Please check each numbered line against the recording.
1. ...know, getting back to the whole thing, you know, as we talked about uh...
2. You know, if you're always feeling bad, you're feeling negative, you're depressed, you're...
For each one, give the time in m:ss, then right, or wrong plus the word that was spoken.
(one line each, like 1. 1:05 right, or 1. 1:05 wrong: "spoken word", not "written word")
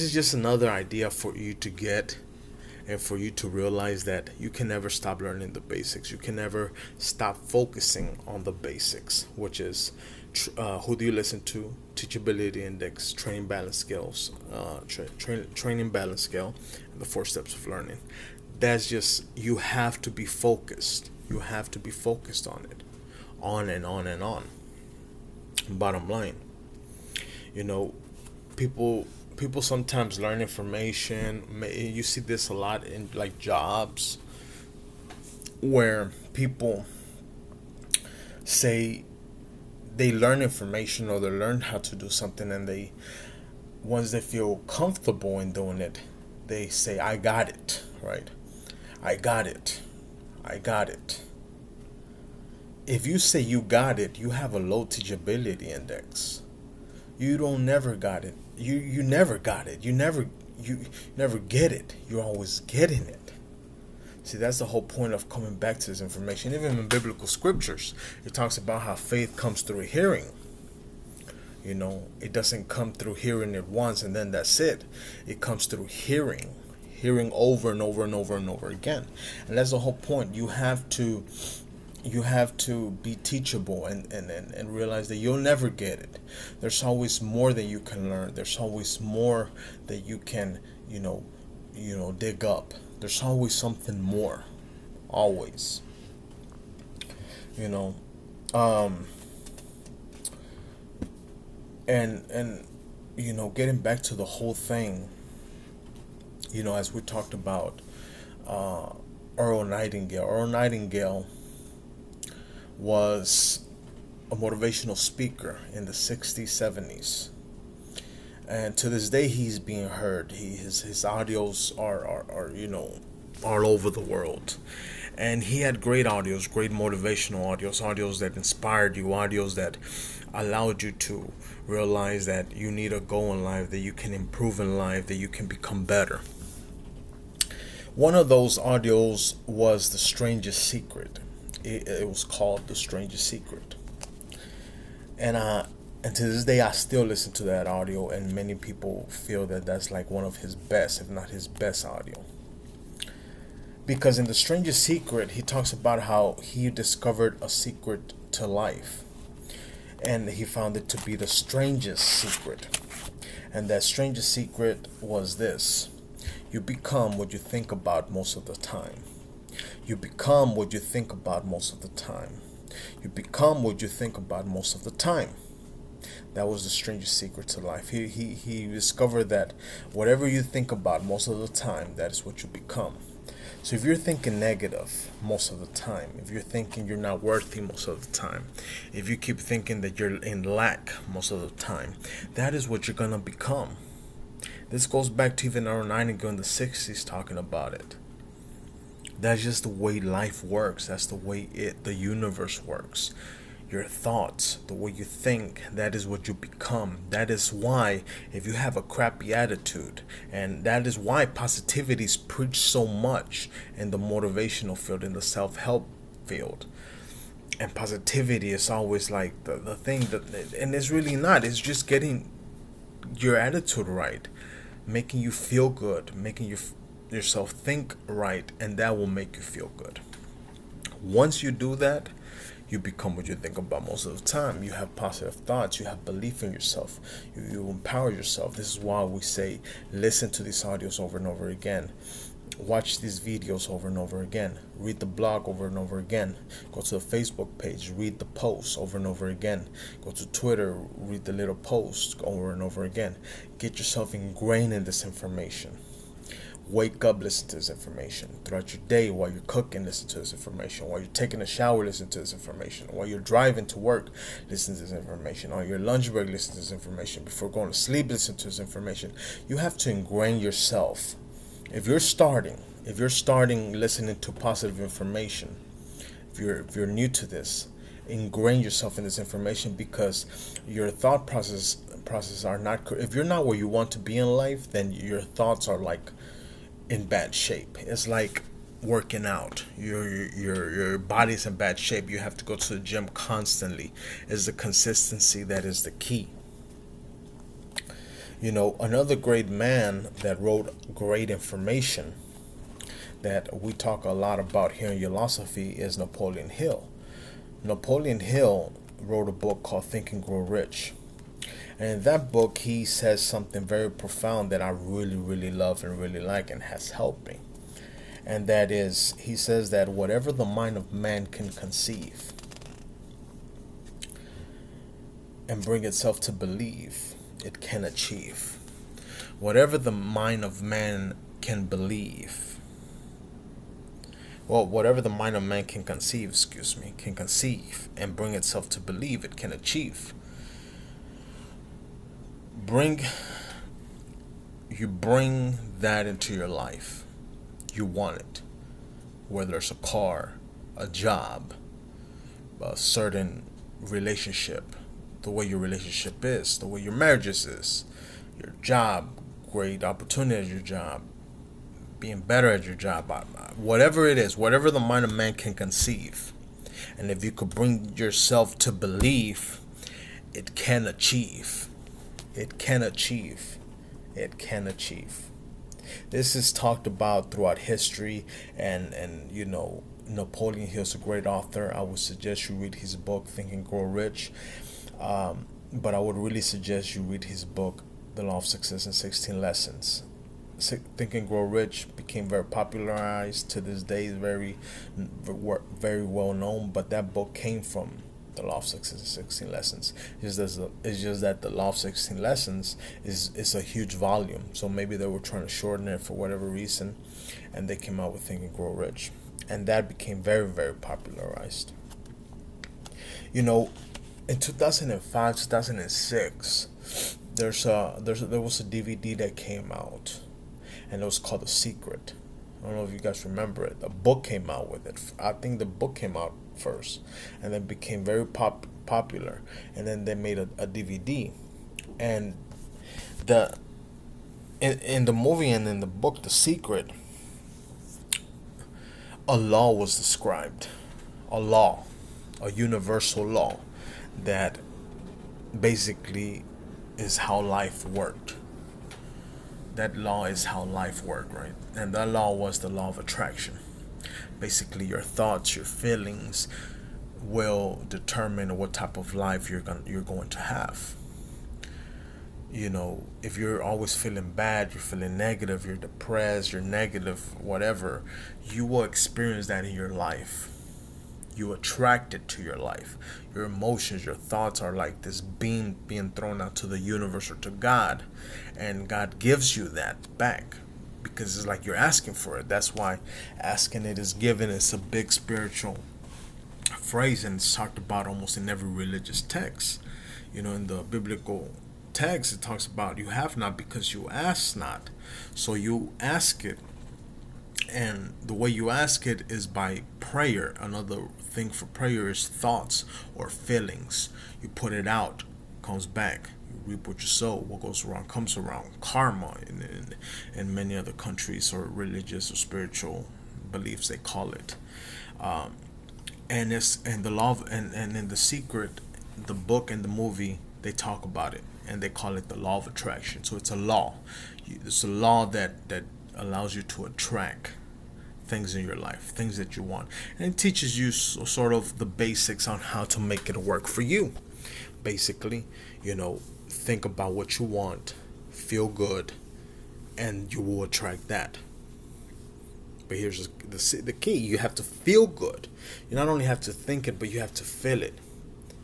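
1. 1:43 right
2. 7:42 right.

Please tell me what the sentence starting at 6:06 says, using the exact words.
And if you could bring yourself to believe, it can achieve it can achieve.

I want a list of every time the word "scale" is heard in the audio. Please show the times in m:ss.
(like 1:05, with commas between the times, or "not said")
0:16.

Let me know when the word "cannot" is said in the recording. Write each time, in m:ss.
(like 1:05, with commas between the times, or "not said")
not said.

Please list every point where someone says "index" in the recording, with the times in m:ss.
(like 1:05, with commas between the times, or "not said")
0:12, 0:55.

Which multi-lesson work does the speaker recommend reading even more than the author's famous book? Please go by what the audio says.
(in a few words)
The Law of Success in 16 Lessons.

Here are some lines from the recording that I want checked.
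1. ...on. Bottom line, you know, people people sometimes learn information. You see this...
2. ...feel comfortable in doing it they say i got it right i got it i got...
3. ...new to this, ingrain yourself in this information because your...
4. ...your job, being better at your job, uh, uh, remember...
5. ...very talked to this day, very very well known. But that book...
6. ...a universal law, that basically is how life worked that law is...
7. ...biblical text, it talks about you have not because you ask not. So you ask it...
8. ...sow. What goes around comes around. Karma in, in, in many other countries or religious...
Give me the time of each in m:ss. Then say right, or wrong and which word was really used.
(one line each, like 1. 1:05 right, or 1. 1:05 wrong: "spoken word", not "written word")
1. 0:24 right
2. 0:44 right
3. 4:36 right
4. 6:00 wrong: "whatever", not "remember"
5. 6:32 wrong: "popularized", not "talked"
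6. 7:22 right
7. 8:10 right
8. 8:27 right.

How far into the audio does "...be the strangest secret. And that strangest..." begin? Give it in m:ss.
2:41.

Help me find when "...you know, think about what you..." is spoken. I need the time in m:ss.
8:55.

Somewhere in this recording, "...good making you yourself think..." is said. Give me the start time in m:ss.
3:45.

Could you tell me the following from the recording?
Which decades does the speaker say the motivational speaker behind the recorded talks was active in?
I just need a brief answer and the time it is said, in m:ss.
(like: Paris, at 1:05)
60s, 70s, at 1:55.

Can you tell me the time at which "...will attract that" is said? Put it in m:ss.
9:00.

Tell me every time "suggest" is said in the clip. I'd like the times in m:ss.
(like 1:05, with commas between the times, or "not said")
6:21, 6:26.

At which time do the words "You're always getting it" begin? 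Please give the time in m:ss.
1:02.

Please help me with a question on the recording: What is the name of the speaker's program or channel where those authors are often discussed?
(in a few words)
Ulosophy.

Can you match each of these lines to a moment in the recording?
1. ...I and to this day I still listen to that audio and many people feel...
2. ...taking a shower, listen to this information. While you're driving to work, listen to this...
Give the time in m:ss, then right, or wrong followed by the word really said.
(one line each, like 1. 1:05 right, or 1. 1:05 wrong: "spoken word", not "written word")
1. 2:25 right
2. 4:21 right.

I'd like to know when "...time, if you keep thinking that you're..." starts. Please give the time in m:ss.
3:08.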